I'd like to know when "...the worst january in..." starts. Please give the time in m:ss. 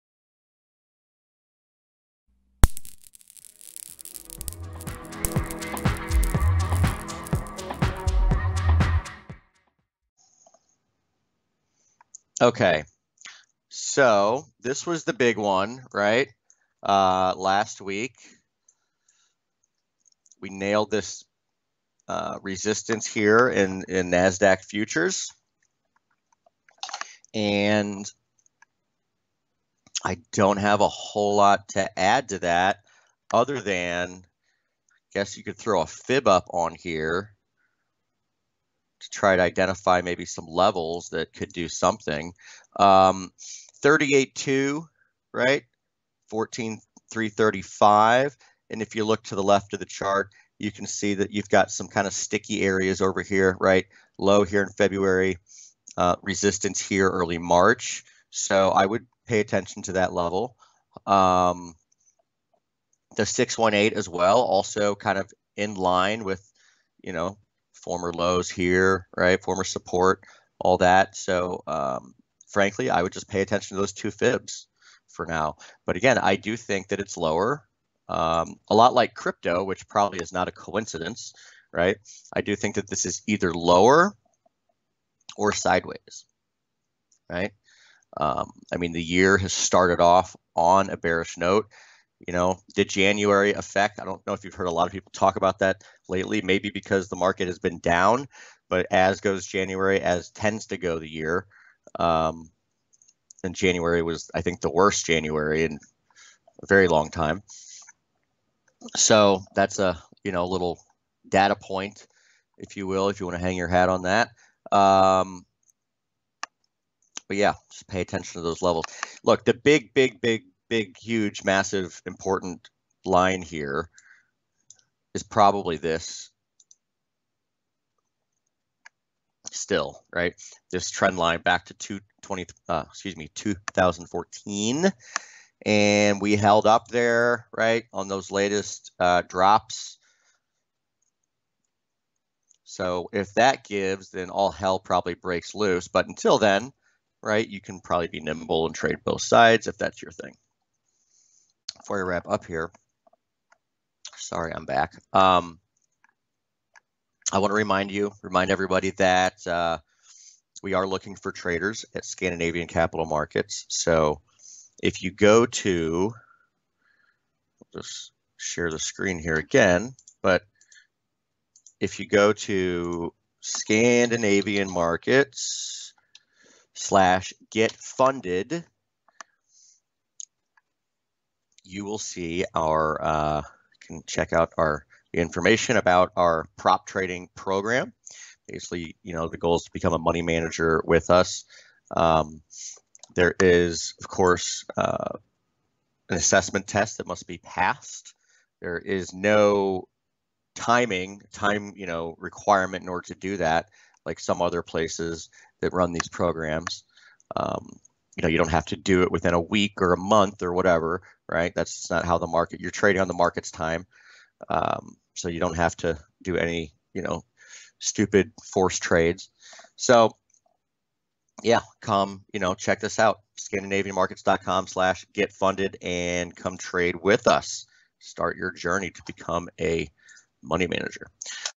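1:44.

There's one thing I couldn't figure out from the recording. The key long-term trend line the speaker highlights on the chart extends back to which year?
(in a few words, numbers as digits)
2014.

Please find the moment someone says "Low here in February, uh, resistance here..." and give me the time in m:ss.
0:54.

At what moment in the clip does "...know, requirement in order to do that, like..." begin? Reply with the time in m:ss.
3:21.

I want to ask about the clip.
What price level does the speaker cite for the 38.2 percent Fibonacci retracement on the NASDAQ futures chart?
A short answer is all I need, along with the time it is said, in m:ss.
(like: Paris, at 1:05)
14,335, at 0:46.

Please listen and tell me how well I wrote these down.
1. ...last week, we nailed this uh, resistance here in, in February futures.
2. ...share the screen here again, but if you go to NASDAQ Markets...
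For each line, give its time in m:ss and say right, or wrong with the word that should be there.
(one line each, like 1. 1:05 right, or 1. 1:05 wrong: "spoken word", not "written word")
1. 0:17 wrong: "NASDAQ", not "February"
2. 2:48 wrong: "Scandinavian", not "NASDAQ".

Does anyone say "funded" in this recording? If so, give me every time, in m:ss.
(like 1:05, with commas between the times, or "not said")
2:57, 3:45.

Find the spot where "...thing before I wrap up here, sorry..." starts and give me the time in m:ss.
2:30.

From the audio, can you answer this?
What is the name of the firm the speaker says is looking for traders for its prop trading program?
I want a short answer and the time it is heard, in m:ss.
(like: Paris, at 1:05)
Scandinavian Capital Markets, at 2:42.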